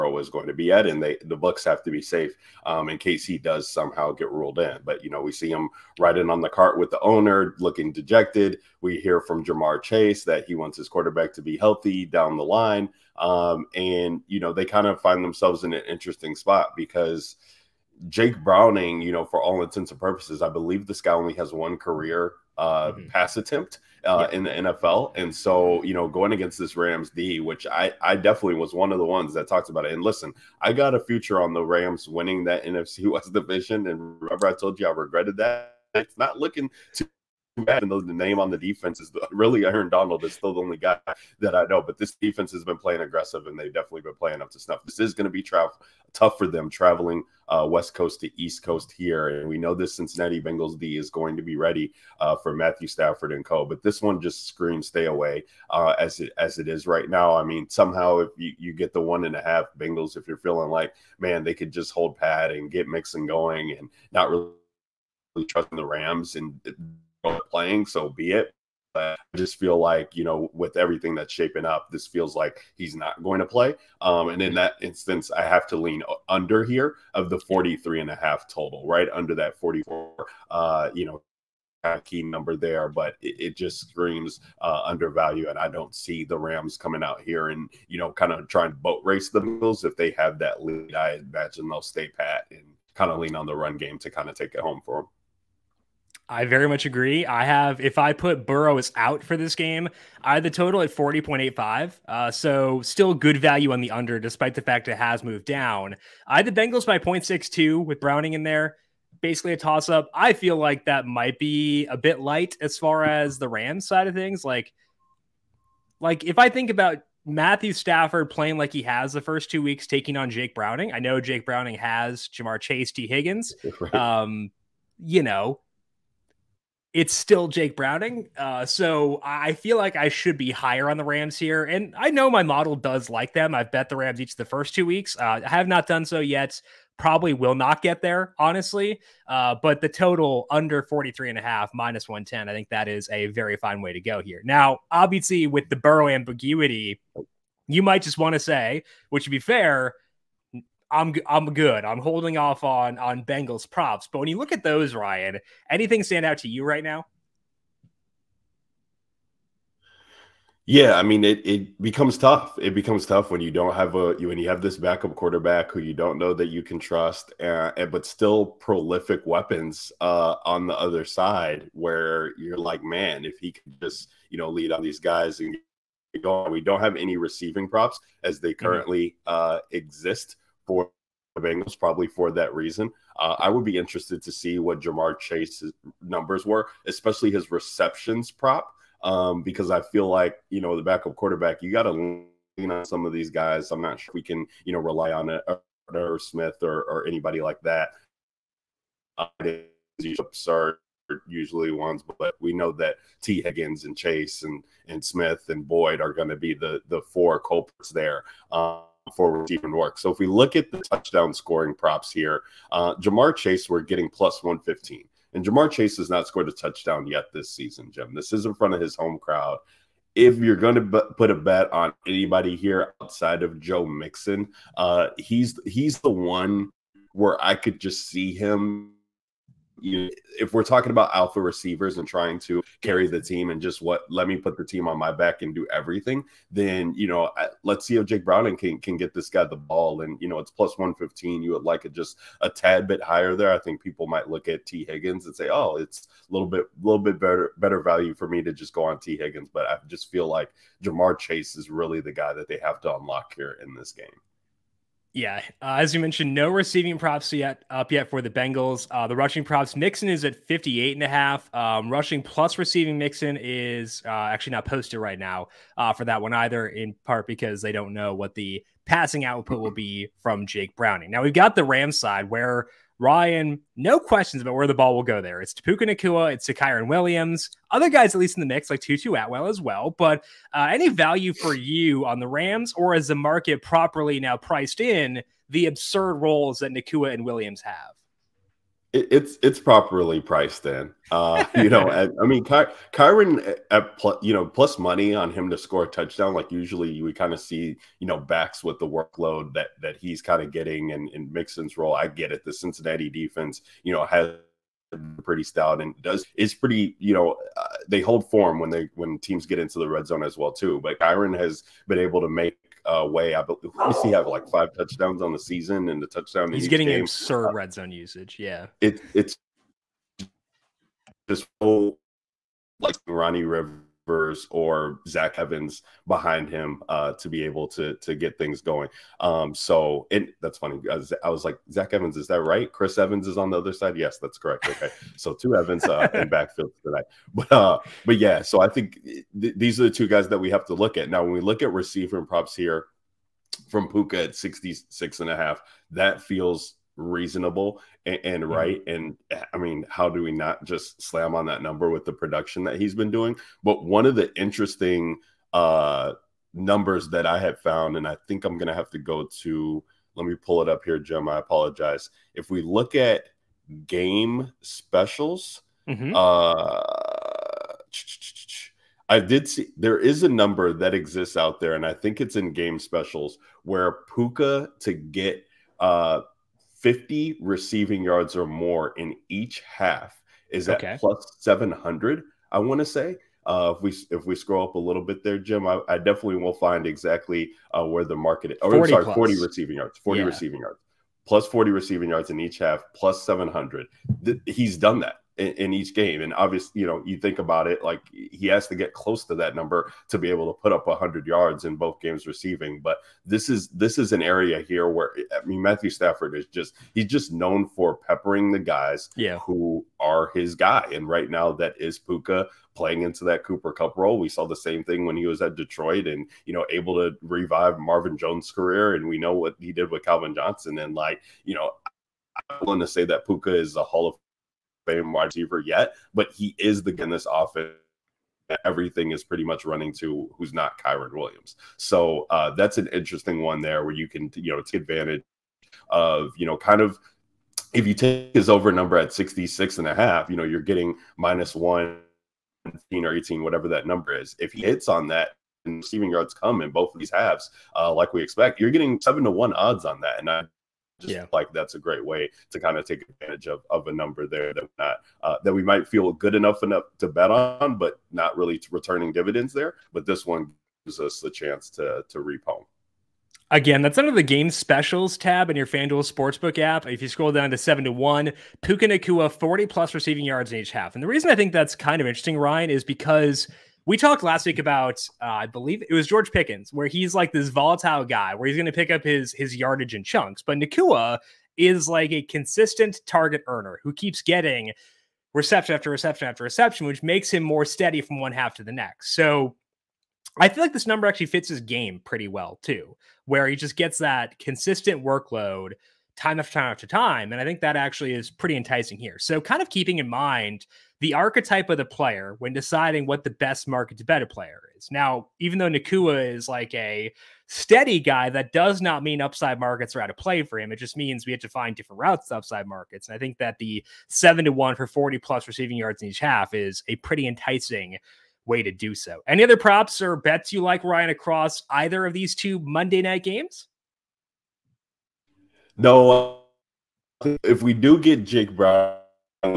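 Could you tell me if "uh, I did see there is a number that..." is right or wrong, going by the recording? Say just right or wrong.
right.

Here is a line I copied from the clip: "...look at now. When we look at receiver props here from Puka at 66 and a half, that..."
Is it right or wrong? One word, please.
right.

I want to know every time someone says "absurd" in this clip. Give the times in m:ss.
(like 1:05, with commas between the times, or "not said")
4:45, 5:17.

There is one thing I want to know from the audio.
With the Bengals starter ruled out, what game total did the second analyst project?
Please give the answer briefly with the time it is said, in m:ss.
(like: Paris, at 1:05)
40.85, at 1:40.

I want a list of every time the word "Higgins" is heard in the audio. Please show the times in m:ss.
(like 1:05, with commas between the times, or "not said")
2:03, 3:23, 4:04, 4:09.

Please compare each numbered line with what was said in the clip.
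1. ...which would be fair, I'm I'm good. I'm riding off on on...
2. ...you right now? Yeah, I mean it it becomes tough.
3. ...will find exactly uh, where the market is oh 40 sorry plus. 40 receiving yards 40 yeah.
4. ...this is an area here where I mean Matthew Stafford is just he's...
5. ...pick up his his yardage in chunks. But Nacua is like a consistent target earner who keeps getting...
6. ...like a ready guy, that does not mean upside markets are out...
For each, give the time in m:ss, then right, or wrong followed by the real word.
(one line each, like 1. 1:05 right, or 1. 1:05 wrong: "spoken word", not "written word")
1. 2:29 wrong: "holding", not "riding"
2. 2:36 right
3. 6:26 right
4. 6:43 right
5. 7:58 right
6. 8:26 wrong: "steady", not "ready".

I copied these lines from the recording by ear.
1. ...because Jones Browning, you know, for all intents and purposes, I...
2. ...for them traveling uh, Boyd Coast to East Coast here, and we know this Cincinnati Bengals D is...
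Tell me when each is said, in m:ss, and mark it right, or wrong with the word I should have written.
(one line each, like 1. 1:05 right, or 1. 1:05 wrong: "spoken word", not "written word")
1. 0:16 wrong: "Jake", not "Jones"
2. 0:46 wrong: "West", not "Boyd".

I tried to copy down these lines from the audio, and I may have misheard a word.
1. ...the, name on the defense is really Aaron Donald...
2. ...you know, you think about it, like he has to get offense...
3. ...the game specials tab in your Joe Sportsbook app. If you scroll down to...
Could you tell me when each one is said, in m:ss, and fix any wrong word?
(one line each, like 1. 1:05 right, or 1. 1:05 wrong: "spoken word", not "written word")
1. 0:37 right
2. 6:36 wrong: "close", not "offense"
3. 7:44 wrong: "FanDuel", not "Joe".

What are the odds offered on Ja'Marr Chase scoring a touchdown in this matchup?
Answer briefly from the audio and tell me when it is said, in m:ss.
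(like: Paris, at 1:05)
+115, at 3:34.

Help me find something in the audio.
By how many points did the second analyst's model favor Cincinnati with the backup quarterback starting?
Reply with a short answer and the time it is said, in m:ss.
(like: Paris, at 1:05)
0.62, at 1:46.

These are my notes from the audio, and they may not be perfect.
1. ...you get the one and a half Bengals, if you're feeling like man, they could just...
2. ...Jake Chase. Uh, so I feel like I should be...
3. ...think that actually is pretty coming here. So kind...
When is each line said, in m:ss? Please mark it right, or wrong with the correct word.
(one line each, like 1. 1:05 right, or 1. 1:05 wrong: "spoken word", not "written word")
1. 0:58 right
2. 2:07 wrong: "Browning", not "Chase"
3. 8:17 wrong: "enticing", not "coming".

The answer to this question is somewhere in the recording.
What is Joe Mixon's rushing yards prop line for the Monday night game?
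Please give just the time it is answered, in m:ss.
4:20.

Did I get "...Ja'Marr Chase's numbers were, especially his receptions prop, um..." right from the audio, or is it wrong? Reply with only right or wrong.
right.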